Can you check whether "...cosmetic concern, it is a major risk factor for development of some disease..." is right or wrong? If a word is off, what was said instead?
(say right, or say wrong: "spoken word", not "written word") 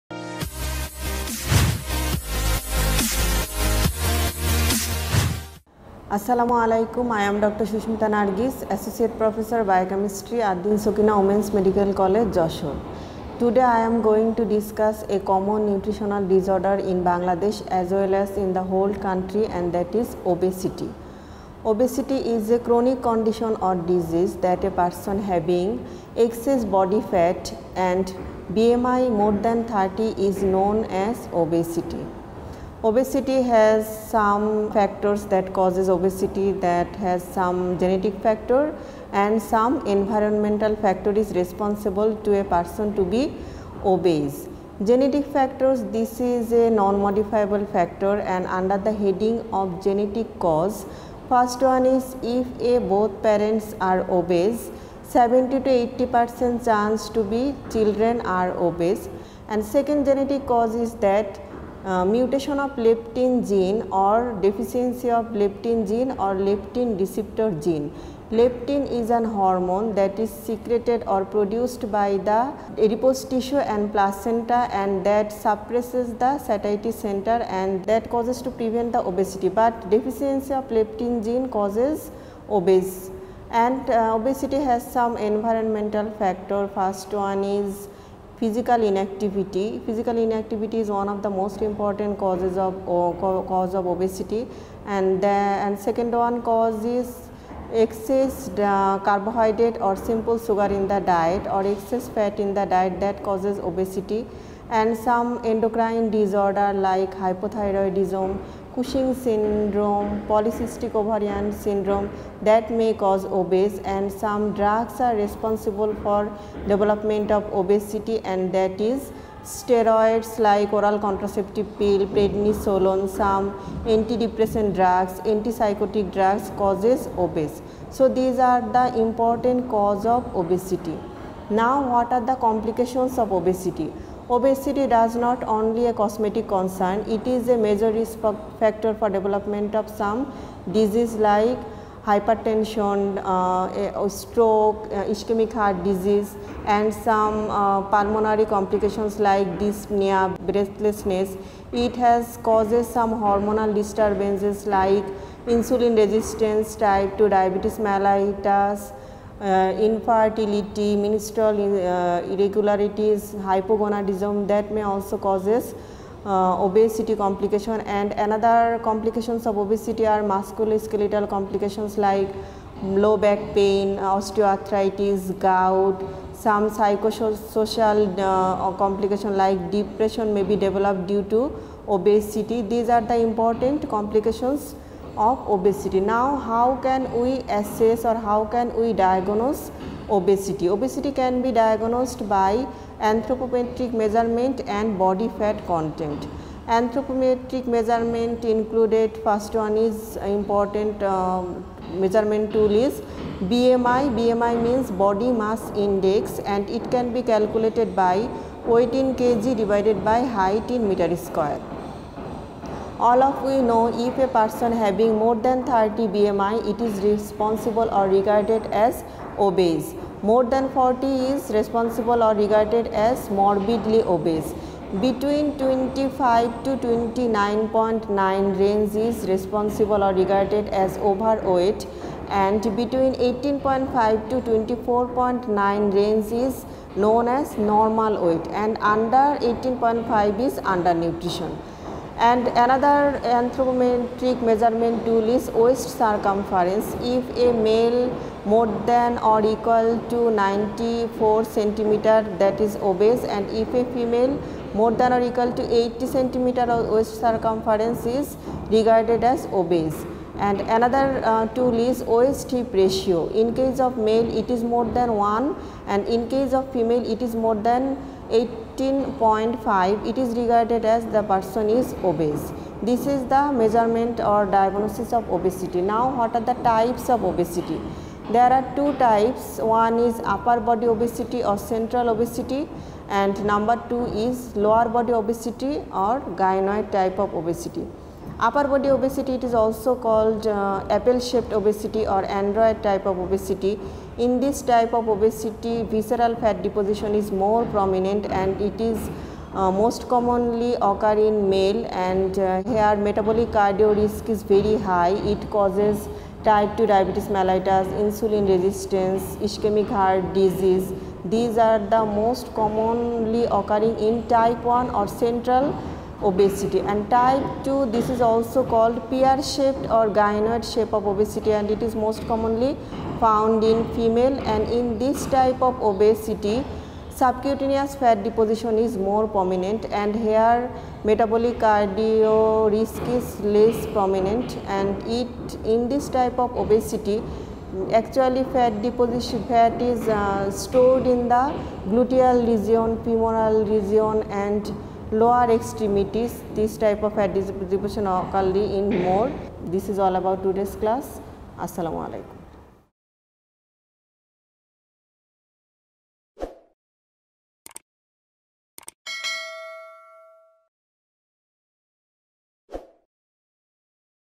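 right.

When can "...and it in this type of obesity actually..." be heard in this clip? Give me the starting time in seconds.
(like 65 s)
334 s.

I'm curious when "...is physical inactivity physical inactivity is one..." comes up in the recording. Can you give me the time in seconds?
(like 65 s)
87 s.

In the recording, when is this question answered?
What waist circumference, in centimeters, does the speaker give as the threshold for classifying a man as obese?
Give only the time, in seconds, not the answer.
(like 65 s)
250 s.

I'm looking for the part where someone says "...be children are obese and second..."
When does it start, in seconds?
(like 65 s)
57 s.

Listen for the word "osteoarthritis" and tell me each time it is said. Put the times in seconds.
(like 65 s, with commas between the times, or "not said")
173 s.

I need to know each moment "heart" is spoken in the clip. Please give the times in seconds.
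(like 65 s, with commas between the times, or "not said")
145 s, 309 s.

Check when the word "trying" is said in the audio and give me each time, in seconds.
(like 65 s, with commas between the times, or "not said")
not said.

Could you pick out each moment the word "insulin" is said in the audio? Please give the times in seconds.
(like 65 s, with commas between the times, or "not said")
155 s, 308 s.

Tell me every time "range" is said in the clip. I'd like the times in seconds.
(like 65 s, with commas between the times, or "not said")
228 s, 235 s.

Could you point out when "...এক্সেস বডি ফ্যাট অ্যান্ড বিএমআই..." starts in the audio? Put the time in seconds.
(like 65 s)
26 s.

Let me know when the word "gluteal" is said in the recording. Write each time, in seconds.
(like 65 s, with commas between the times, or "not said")
341 s.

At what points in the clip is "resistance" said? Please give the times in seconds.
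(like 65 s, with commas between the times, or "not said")
155 s, 308 s.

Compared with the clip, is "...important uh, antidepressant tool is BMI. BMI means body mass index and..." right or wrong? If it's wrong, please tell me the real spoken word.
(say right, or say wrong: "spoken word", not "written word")
wrong: "measurement", not "antidepressant".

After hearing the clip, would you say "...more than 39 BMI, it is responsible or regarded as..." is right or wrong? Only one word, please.
wrong.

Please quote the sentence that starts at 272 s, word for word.
This is the measurement or diagnosis of obesity.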